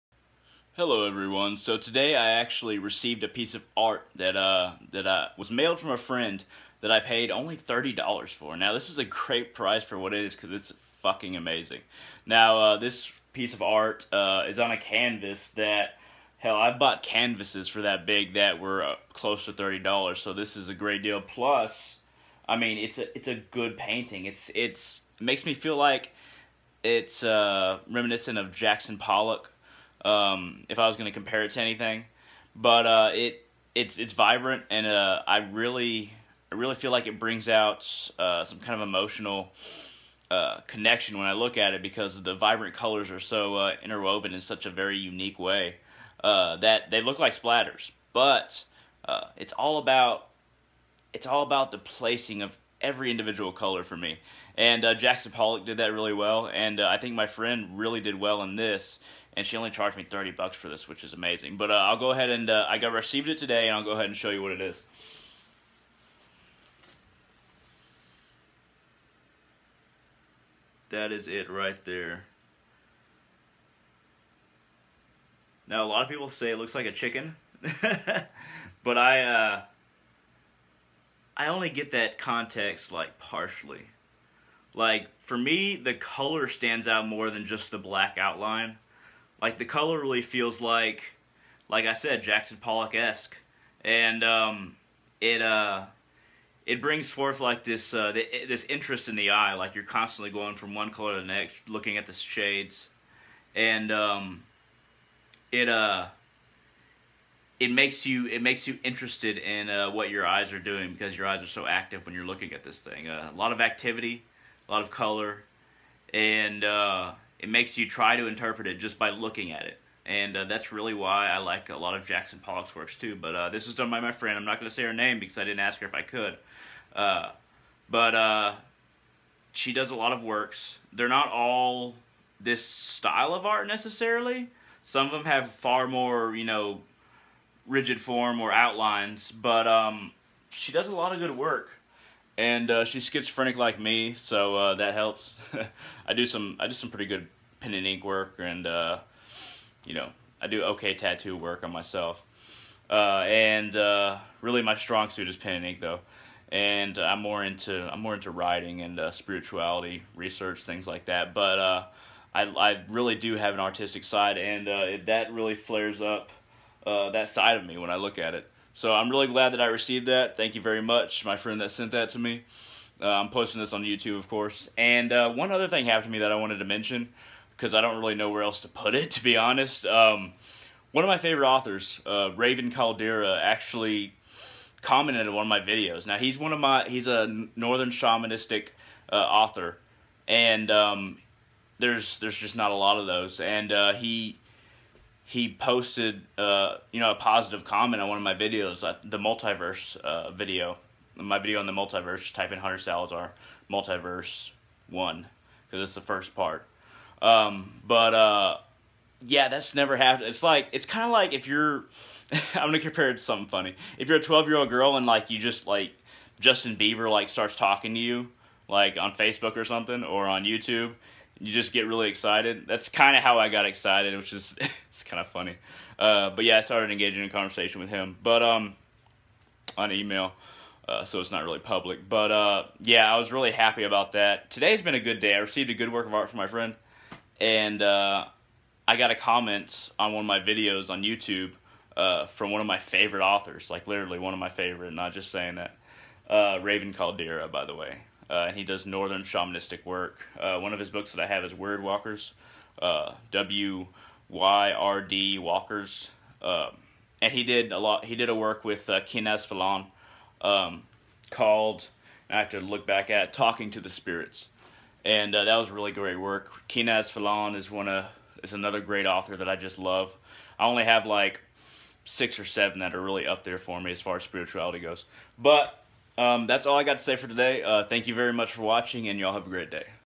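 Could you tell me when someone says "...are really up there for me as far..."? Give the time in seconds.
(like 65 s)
272 s.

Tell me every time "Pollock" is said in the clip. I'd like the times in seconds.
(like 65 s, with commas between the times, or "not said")
28 s, 55 s, 92 s, 122 s.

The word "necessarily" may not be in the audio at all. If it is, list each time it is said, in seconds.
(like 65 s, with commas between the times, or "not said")
133 s.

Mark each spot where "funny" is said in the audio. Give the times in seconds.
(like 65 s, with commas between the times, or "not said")
213 s, 225 s.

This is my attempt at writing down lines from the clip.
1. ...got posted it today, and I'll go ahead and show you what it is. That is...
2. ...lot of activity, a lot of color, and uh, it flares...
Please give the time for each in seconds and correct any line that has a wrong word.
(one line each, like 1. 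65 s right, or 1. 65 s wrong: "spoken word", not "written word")
1. 62 s wrong: "received", not "posted"
2. 113 s wrong: "makes", not "flares".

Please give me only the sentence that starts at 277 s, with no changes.
Uh, thank you very much for watching, and y'all have a great day.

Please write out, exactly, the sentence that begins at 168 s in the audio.
So I'm really glad that I received that.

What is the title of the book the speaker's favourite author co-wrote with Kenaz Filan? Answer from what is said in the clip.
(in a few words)
Talking to the Spirits.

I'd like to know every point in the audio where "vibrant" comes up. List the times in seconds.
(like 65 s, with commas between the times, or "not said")
34 s, 42 s.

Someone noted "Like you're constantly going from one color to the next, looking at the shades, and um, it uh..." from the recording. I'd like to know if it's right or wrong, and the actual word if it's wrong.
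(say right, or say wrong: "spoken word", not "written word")
right.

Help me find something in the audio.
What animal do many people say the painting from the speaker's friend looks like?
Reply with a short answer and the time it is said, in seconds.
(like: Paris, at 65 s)
Chicken, at 76 s.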